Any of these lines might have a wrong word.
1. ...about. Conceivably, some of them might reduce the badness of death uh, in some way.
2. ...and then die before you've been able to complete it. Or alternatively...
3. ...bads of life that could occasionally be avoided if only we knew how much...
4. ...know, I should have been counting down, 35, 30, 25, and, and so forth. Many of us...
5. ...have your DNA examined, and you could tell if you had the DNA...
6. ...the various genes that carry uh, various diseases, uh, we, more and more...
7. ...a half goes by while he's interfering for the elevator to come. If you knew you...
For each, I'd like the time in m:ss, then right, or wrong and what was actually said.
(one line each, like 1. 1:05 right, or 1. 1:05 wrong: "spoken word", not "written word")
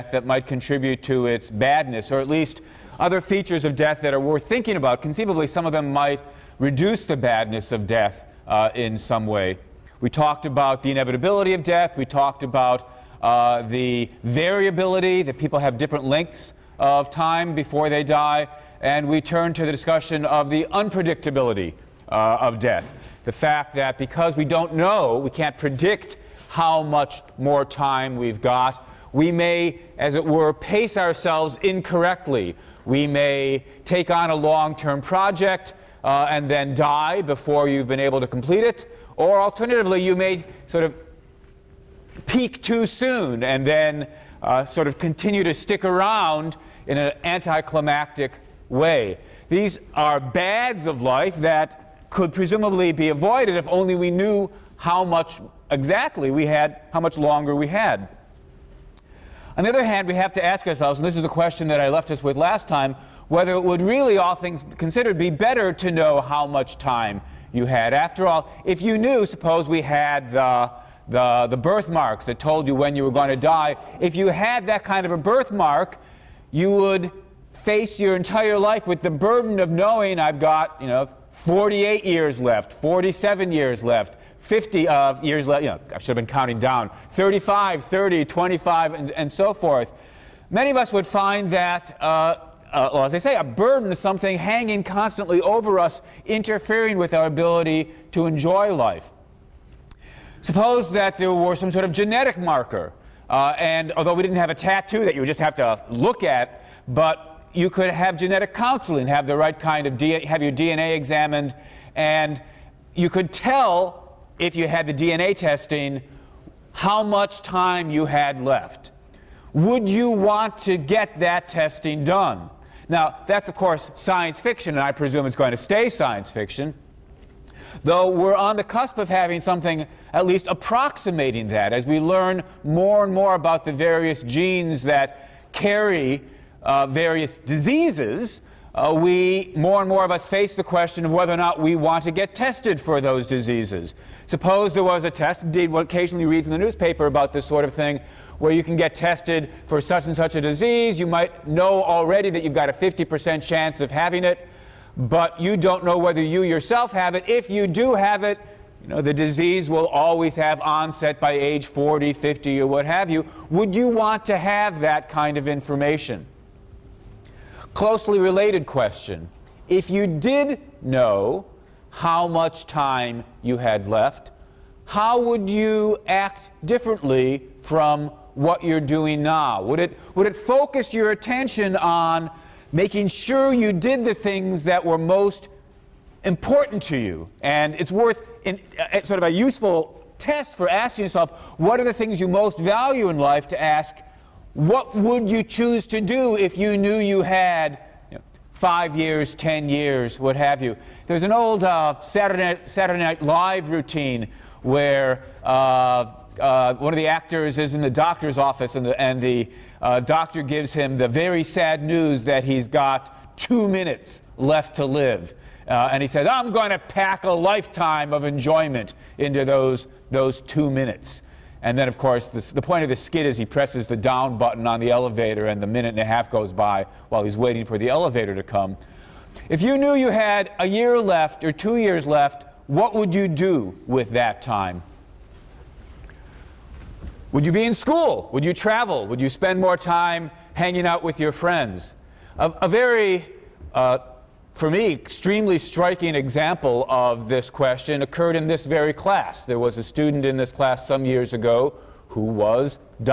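1. 0:04 right
2. 0:36 right
3. 0:50 wrong: "presumably", not "occasionally"
4. 1:25 right
5. 1:50 right
6. 2:13 right
7. 3:45 wrong: "waiting", not "interfering".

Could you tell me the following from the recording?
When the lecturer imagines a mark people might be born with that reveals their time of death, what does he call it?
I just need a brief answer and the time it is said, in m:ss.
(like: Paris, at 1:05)
birthmarks, at 1:11.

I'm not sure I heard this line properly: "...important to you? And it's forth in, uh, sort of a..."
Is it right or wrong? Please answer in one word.
wrong.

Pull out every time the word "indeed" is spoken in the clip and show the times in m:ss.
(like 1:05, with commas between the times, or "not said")
2:25.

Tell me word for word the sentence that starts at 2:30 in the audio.
You might know already that you've got a 50% chance of having it, but you don't know whether you yourself have it.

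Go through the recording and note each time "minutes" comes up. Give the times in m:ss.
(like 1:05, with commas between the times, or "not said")
3:33, 3:40, 3:45.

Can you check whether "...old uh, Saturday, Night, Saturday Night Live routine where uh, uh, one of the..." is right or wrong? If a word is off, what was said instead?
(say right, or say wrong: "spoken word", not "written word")
right.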